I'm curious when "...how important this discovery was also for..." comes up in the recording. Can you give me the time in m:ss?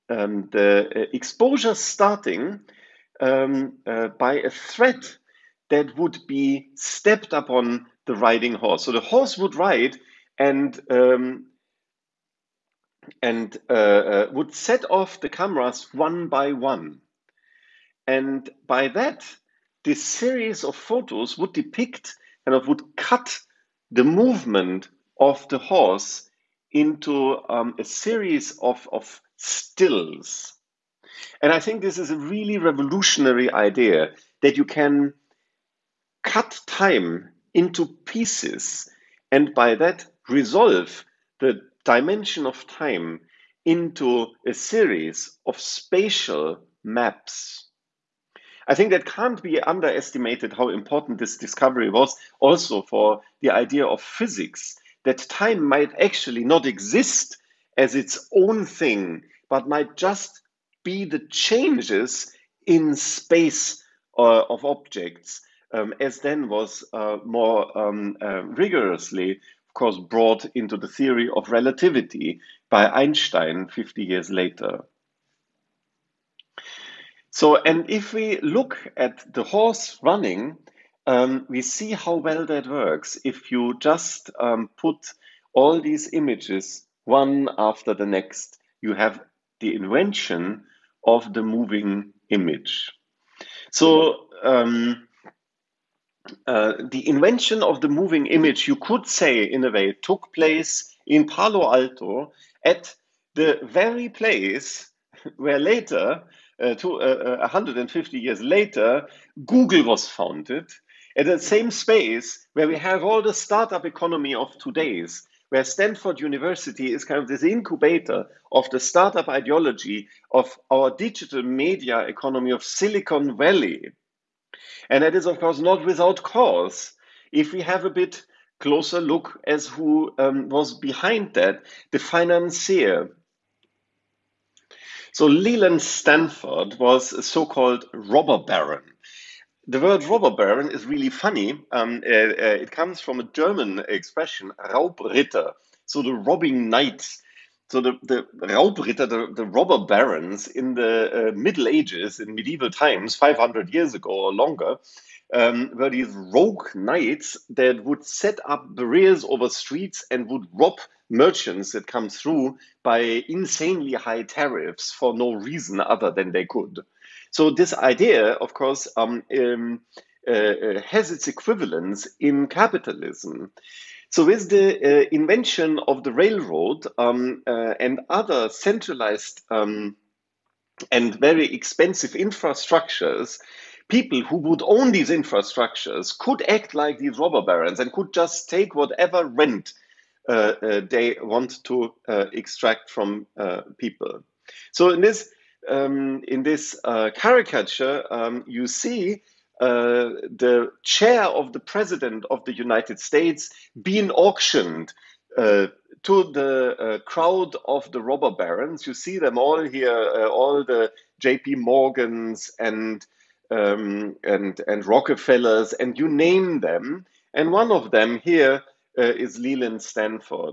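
0:50.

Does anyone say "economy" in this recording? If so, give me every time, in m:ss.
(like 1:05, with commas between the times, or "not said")
1:53, 2:02.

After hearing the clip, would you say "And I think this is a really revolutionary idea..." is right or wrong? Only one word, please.
right.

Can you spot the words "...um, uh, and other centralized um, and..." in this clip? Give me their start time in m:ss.
2:56.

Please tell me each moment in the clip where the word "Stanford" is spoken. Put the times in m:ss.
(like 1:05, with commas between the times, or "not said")
1:55, 2:15, 3:39.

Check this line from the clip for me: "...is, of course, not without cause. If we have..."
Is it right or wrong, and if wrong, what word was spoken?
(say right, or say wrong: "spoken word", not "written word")
right.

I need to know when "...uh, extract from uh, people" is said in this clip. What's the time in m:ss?
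3:12.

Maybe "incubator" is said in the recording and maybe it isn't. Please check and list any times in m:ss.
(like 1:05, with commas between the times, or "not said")
1:57.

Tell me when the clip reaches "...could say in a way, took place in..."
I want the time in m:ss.
1:38.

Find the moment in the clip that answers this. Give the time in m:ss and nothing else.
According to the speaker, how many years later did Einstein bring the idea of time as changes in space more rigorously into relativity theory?
1:13.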